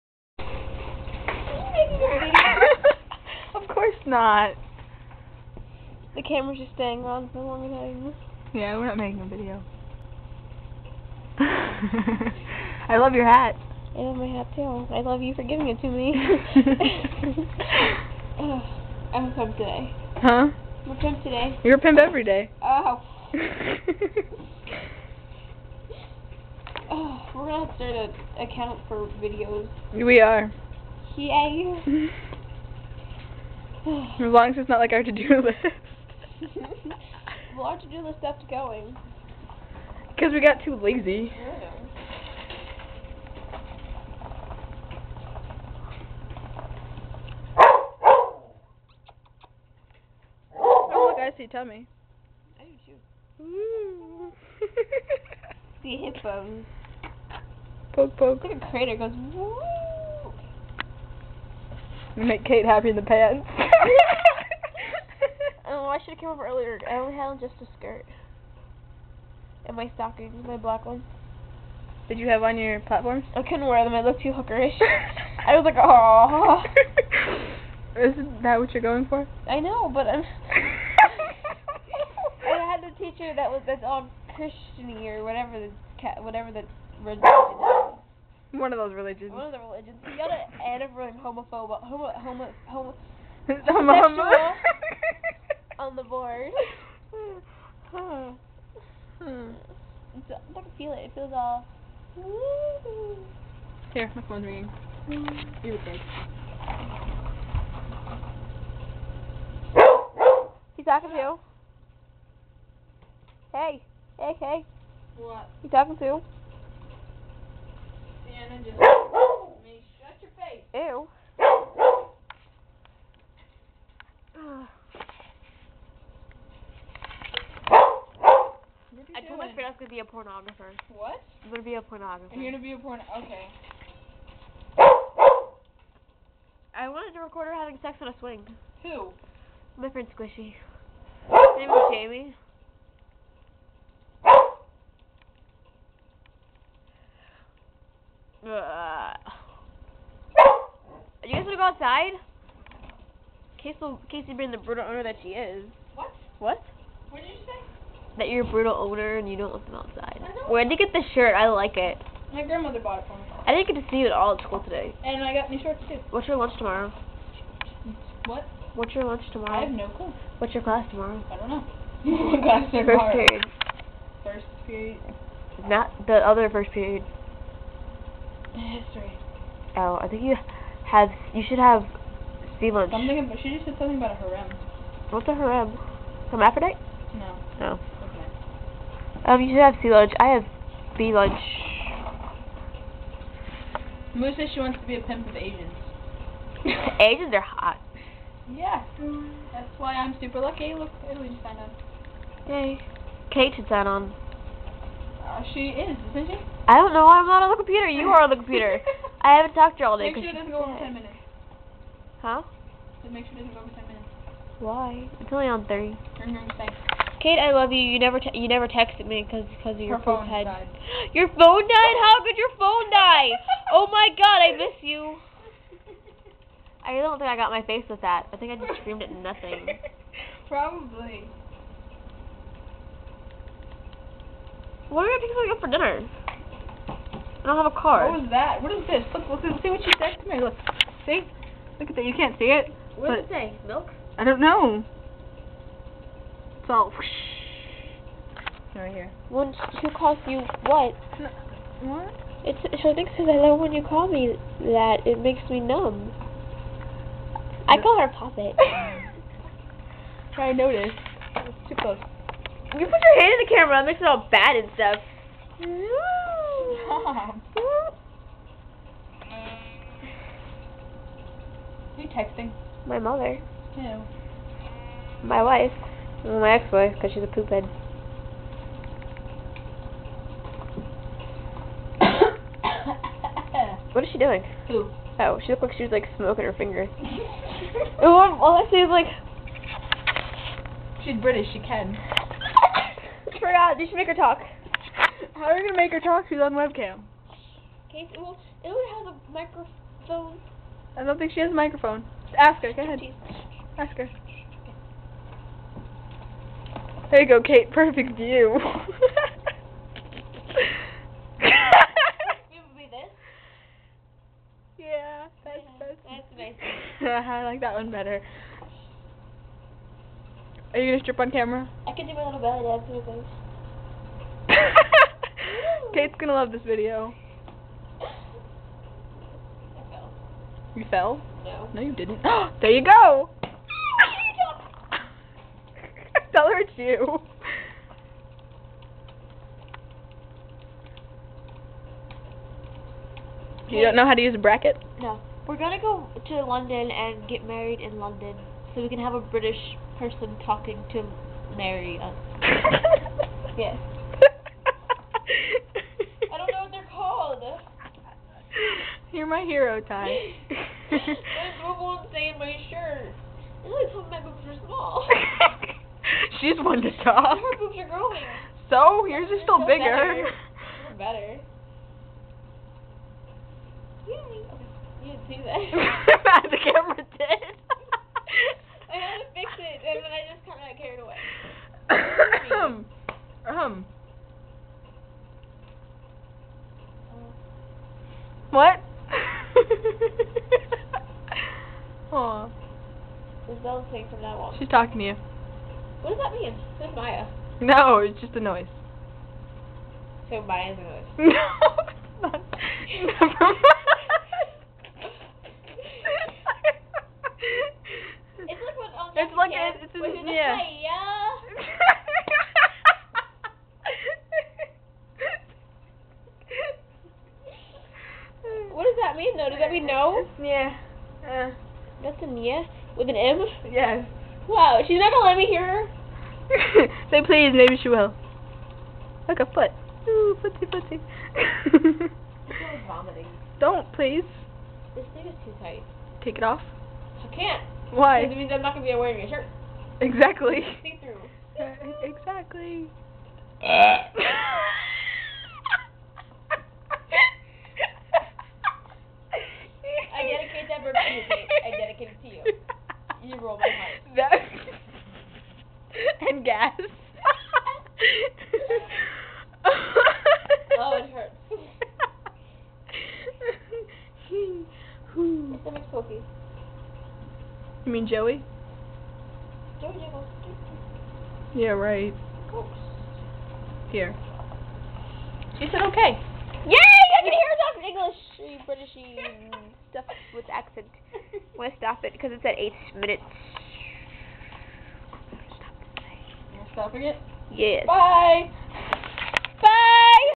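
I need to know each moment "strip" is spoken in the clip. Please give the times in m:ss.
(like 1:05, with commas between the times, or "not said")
5:21.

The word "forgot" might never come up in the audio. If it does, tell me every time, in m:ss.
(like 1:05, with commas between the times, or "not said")
4:53.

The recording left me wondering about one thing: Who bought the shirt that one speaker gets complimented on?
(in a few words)
My grandmother.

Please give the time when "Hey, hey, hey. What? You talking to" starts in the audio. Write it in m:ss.
1:53.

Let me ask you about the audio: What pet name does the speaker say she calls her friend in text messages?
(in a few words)
Poppet.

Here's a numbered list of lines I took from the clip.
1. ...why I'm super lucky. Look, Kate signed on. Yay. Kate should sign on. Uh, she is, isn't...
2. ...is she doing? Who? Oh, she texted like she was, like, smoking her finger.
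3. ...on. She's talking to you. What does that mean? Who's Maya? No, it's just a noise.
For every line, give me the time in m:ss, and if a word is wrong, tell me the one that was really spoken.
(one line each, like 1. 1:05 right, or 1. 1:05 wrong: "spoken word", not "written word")
1. 3:19 wrong: "Italy", not "Kate"
2. 4:44 wrong: "looked", not "texted"
3. 6:34 right.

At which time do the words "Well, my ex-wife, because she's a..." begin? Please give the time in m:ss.
4:36.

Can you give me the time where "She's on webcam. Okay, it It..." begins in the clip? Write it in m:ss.
4:56.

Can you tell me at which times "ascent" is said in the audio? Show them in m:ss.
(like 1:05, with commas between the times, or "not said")
not said.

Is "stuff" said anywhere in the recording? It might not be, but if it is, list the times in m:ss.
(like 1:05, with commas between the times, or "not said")
4:24, 7:59.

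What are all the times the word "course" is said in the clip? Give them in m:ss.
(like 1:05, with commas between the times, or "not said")
0:03.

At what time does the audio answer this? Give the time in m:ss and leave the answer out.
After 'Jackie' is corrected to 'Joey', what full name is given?
7:49.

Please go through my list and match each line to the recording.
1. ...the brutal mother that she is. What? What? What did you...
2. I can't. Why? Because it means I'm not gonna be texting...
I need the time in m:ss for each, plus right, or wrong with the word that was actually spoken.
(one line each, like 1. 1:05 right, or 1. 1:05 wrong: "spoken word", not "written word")
1. 2:34 wrong: "owner", not "mother"
2. 7:17 wrong: "wearing", not "texting".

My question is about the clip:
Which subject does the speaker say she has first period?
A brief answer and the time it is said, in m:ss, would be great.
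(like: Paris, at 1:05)
History, at 2:58.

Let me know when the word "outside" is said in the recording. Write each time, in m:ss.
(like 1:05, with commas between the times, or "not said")
2:31, 2:39.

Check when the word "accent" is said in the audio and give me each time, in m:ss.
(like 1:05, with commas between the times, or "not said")
8:00.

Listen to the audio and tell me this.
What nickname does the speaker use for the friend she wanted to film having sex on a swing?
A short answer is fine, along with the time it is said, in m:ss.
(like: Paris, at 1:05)
Squishy, at 2:20.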